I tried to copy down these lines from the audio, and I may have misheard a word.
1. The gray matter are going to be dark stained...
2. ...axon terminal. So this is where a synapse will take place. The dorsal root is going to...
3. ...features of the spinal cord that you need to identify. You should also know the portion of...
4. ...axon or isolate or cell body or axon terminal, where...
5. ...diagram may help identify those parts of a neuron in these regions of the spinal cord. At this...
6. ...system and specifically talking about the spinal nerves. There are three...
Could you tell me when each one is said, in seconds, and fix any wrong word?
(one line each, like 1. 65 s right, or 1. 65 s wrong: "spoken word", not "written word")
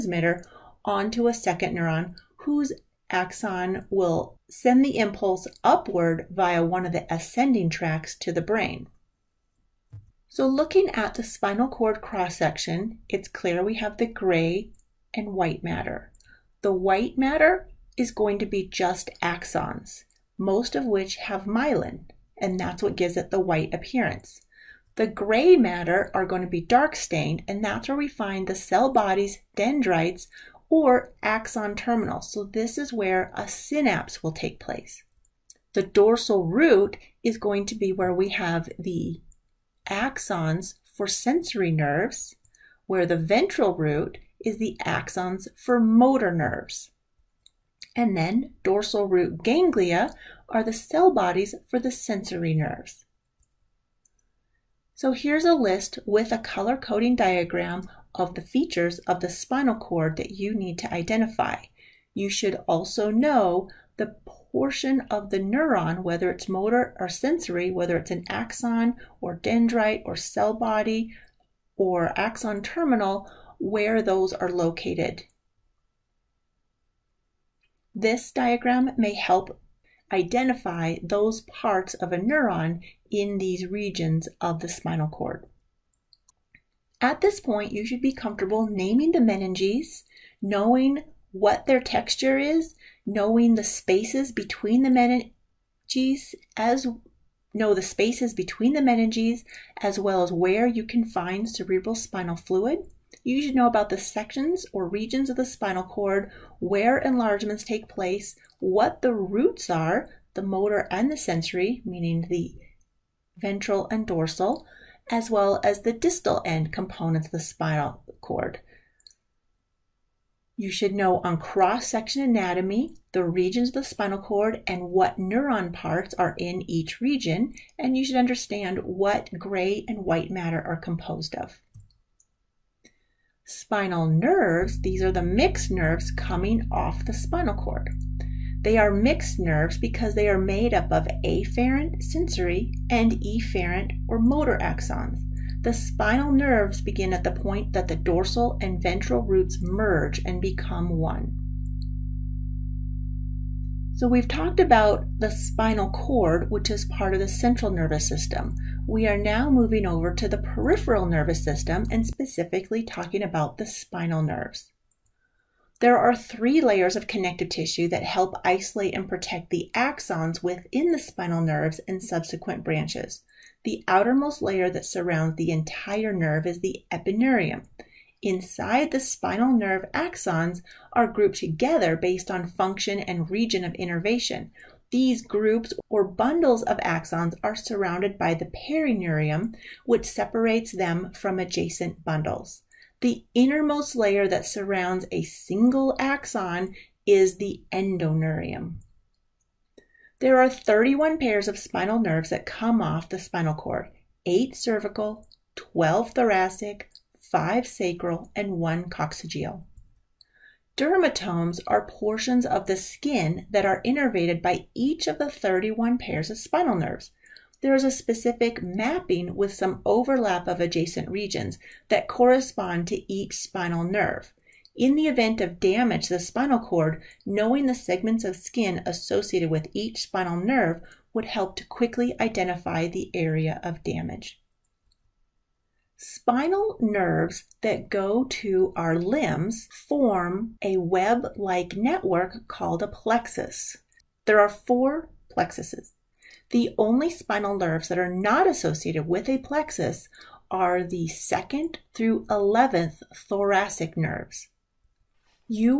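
1. 24 s right
2. 31 s right
3. 58 s right
4. 68 s wrong: "dendrite", not "isolate"
5. 78 s right
6. 161 s right.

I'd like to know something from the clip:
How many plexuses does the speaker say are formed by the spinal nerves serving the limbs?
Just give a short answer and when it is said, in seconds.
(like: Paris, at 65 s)
4, at 244 s.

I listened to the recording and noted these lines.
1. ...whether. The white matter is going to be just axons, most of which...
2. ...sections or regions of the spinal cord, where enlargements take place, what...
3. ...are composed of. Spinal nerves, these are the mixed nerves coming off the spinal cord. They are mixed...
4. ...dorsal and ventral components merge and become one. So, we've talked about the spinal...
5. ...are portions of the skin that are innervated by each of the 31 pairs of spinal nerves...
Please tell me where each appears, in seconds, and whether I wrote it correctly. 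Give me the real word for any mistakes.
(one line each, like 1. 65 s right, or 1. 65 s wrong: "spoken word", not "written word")
1. 15 s wrong: "matter", not "whether"
2. 103 s right
3. 130 s right
4. 147 s wrong: "roots", not "components"
5. 211 s right.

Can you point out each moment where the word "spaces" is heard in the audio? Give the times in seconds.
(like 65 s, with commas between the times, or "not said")
93 s, 97 s.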